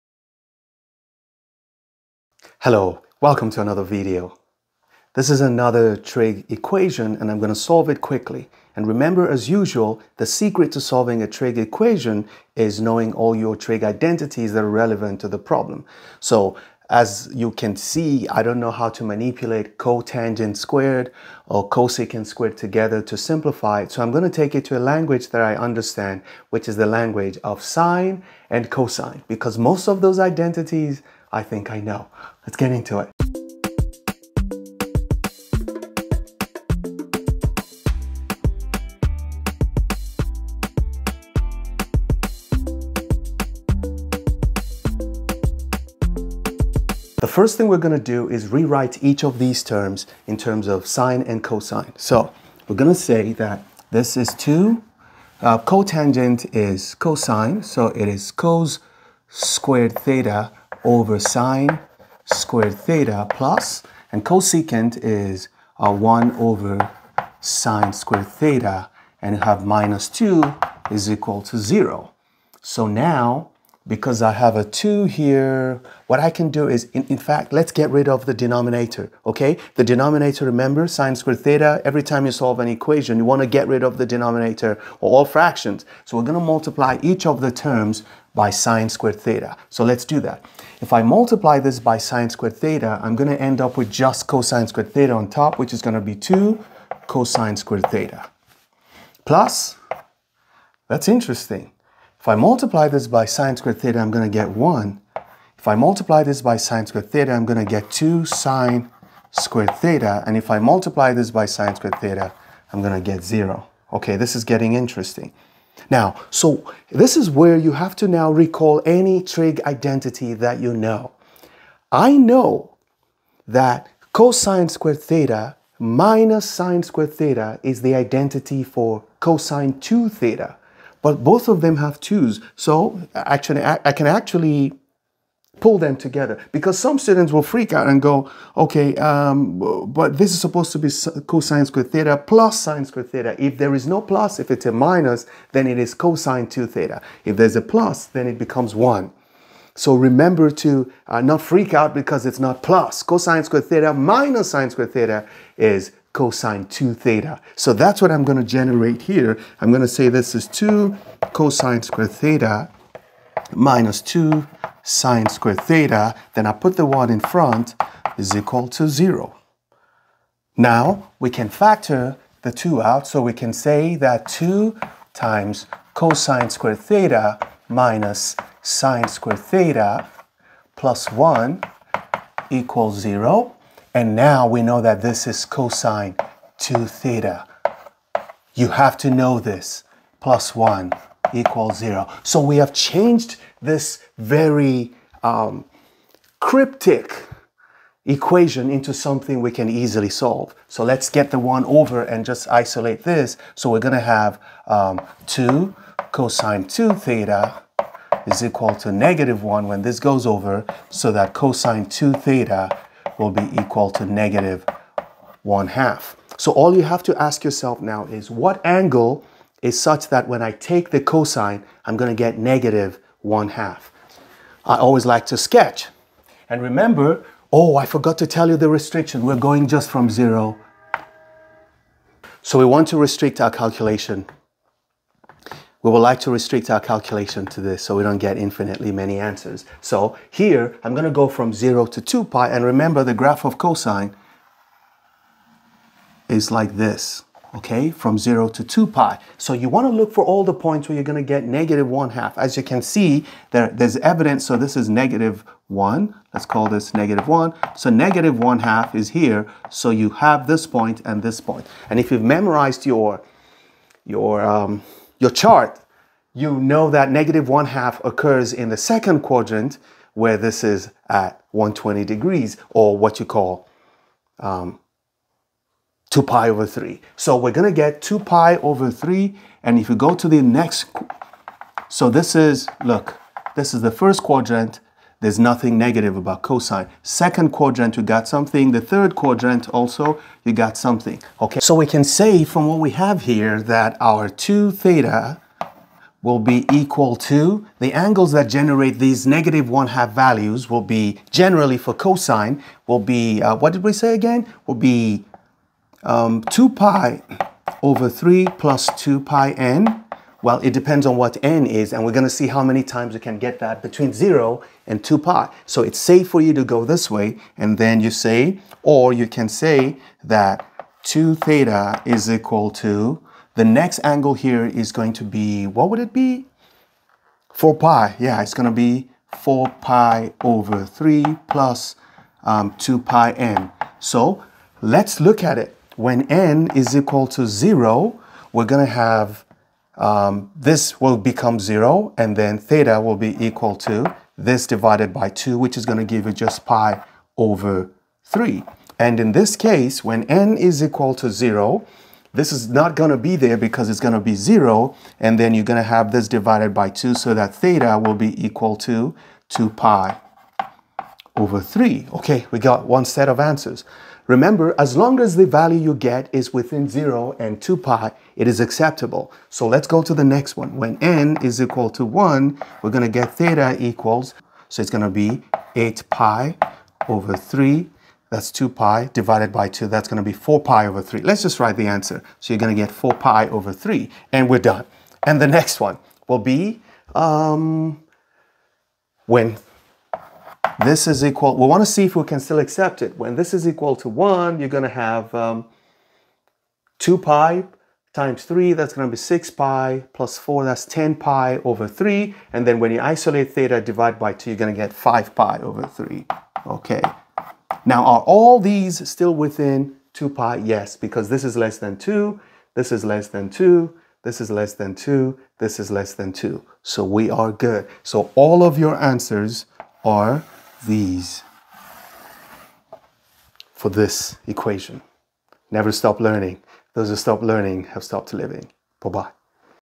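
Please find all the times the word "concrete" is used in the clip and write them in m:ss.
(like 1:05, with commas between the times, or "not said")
not said.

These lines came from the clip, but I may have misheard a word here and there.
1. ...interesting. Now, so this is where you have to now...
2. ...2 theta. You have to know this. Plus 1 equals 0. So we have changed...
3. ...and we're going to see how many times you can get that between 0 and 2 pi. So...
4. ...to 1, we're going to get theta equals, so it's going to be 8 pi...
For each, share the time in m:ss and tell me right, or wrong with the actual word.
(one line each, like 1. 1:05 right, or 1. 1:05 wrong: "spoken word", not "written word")
1. 1:54 right
2. 3:06 right
3. 5:11 right
4. 6:11 right.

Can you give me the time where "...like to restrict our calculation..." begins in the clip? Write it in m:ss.
3:55.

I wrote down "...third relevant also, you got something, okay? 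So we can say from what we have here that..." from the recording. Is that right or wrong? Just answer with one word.
wrong.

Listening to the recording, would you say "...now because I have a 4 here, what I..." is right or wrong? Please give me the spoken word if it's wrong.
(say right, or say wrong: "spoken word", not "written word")
wrong: "2", not "4".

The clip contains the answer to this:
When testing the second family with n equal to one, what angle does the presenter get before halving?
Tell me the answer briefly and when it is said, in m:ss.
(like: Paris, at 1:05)
10 pi over 3, at 6:40.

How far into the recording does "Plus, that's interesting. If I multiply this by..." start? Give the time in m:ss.
1:39.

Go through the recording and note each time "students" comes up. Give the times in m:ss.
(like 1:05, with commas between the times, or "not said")
2:16.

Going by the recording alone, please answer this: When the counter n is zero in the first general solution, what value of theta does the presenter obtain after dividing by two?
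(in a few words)
pi over 3.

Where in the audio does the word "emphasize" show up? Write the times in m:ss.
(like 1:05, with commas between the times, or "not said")
not said.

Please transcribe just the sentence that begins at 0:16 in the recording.
So as you can see, I don't know how to manipulate cotangent squared or cosecant squared together to simplify it.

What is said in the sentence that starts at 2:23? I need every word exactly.
If there is no plus, if it's a minus, then it is cosine 2 theta.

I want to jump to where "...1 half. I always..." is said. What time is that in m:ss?
3:43.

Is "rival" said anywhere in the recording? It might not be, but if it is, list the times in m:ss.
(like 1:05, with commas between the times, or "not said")
not said.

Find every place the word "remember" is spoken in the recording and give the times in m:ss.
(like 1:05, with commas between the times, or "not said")
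0:08, 1:20, 2:29, 3:46, 4:02, 6:04.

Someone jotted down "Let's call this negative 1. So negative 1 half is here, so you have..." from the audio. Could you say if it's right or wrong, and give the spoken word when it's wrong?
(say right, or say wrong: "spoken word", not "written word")
right.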